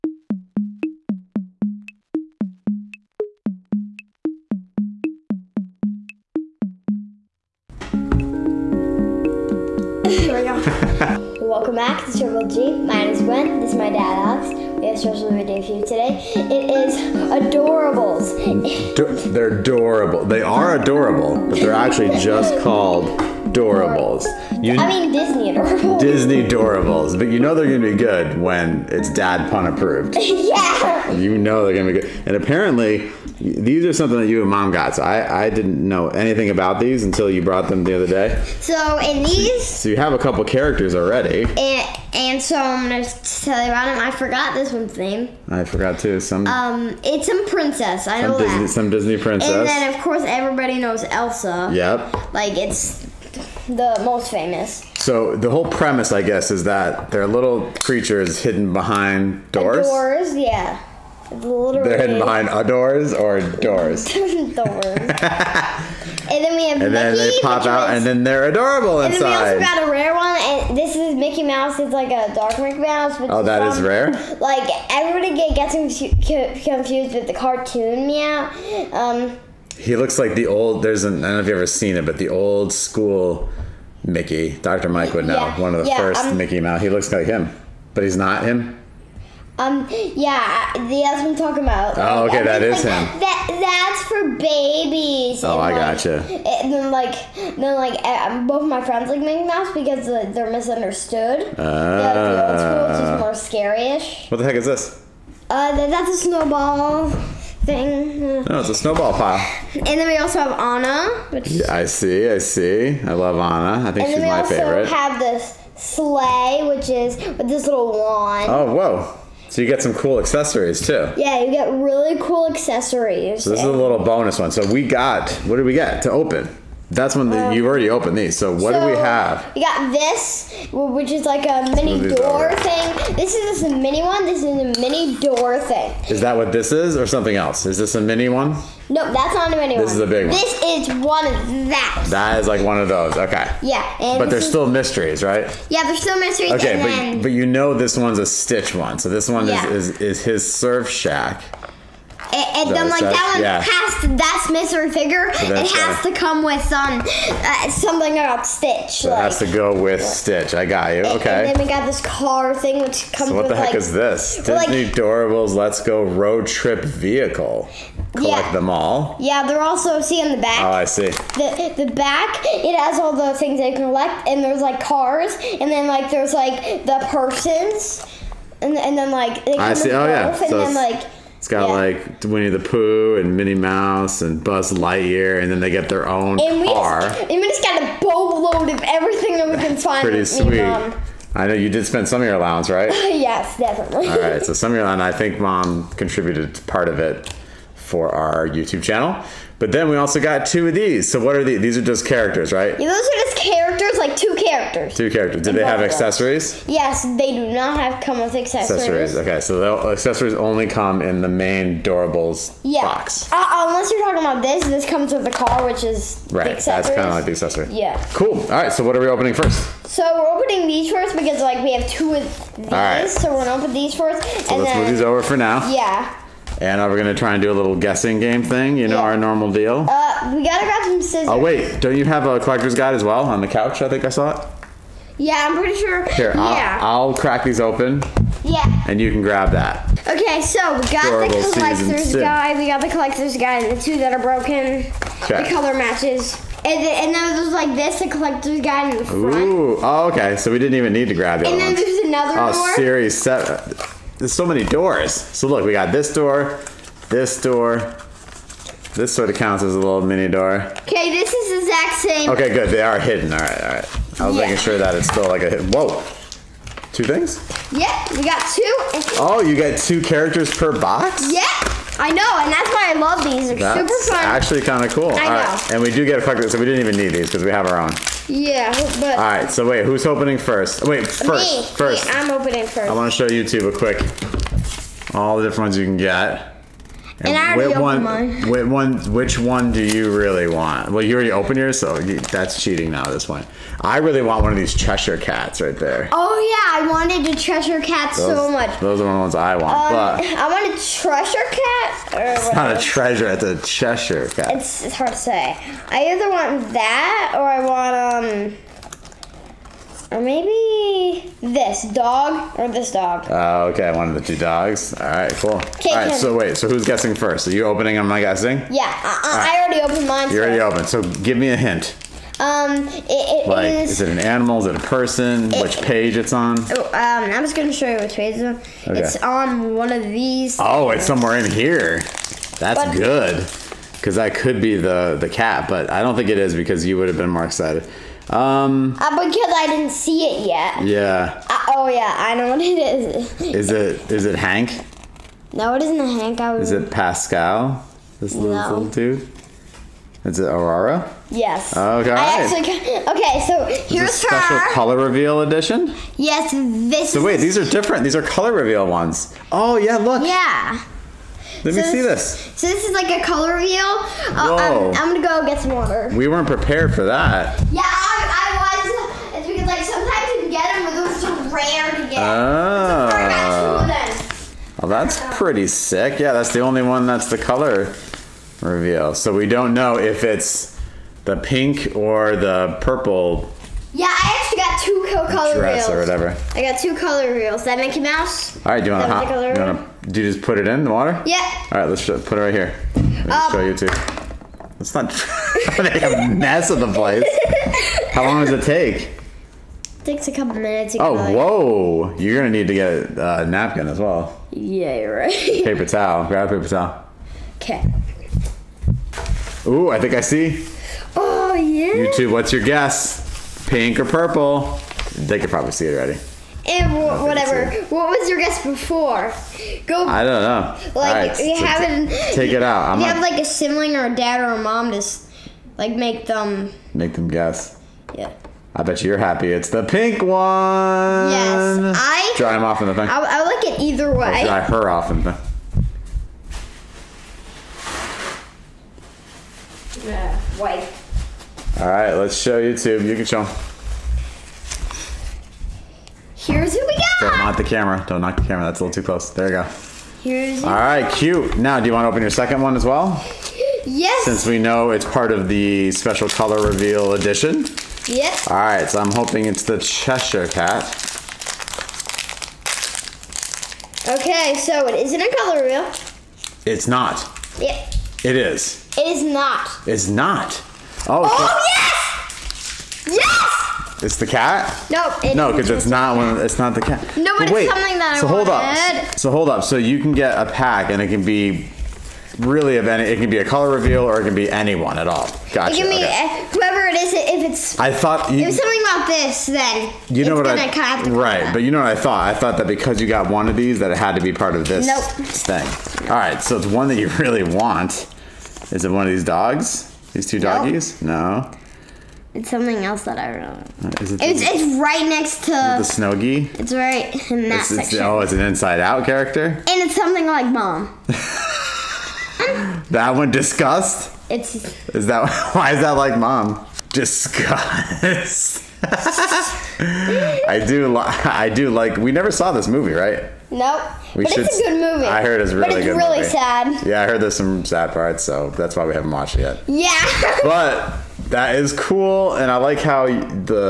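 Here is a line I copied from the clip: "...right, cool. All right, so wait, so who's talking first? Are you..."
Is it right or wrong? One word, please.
wrong.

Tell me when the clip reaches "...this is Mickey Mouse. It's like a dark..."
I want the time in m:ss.
1:10.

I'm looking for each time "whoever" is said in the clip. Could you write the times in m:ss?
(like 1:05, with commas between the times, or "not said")
8:06.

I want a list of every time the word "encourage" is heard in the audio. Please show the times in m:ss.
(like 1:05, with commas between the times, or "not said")
not said.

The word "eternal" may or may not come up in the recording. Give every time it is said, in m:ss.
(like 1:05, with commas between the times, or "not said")
not said.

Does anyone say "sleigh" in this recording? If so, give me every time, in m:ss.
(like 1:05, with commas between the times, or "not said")
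1:55.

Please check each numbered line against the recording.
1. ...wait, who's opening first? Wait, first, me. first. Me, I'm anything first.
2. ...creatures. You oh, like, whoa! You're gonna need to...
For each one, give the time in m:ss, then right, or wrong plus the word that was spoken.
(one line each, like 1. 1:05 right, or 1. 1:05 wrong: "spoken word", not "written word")
1. 4:39 wrong: "opening", not "anything"
2. 6:40 wrong: "minutes", not "creatures".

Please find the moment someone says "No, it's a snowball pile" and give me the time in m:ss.
1:48.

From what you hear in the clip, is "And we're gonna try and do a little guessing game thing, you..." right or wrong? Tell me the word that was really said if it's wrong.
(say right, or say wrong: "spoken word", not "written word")
right.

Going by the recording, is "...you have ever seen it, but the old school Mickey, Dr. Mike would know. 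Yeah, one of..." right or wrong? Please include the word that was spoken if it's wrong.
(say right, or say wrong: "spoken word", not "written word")
right.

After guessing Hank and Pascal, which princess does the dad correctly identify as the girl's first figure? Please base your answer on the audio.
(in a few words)
Aurora.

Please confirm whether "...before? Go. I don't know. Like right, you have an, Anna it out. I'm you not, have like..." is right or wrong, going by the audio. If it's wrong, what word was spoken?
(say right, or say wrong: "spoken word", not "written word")
wrong: "Take", not "Anna".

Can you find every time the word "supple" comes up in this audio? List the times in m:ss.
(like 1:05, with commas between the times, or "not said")
not said.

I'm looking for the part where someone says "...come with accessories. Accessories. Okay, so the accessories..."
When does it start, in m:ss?
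3:28.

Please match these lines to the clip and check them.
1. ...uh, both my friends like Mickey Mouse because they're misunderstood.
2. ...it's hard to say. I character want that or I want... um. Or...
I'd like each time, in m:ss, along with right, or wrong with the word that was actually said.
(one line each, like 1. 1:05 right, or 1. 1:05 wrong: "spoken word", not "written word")
1. 1:38 right
2. 5:04 wrong: "either", not "character".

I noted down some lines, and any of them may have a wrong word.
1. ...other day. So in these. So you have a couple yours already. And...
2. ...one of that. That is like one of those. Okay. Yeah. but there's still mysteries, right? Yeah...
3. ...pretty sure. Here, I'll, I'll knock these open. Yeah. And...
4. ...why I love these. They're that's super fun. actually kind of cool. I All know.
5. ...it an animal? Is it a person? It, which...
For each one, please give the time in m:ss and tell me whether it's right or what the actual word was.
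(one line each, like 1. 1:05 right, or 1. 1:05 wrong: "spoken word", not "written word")
1. 0:37 wrong: "characters", not "yours"
2. 2:21 right
3. 3:55 wrong: "crack", not "knock"
4. 4:32 right
5. 5:24 right.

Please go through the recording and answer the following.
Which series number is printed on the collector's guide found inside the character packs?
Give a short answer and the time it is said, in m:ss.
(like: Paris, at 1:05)
7, at 4:13.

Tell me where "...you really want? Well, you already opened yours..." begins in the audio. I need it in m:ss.
4:49.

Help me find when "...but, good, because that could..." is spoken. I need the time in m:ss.
5:32.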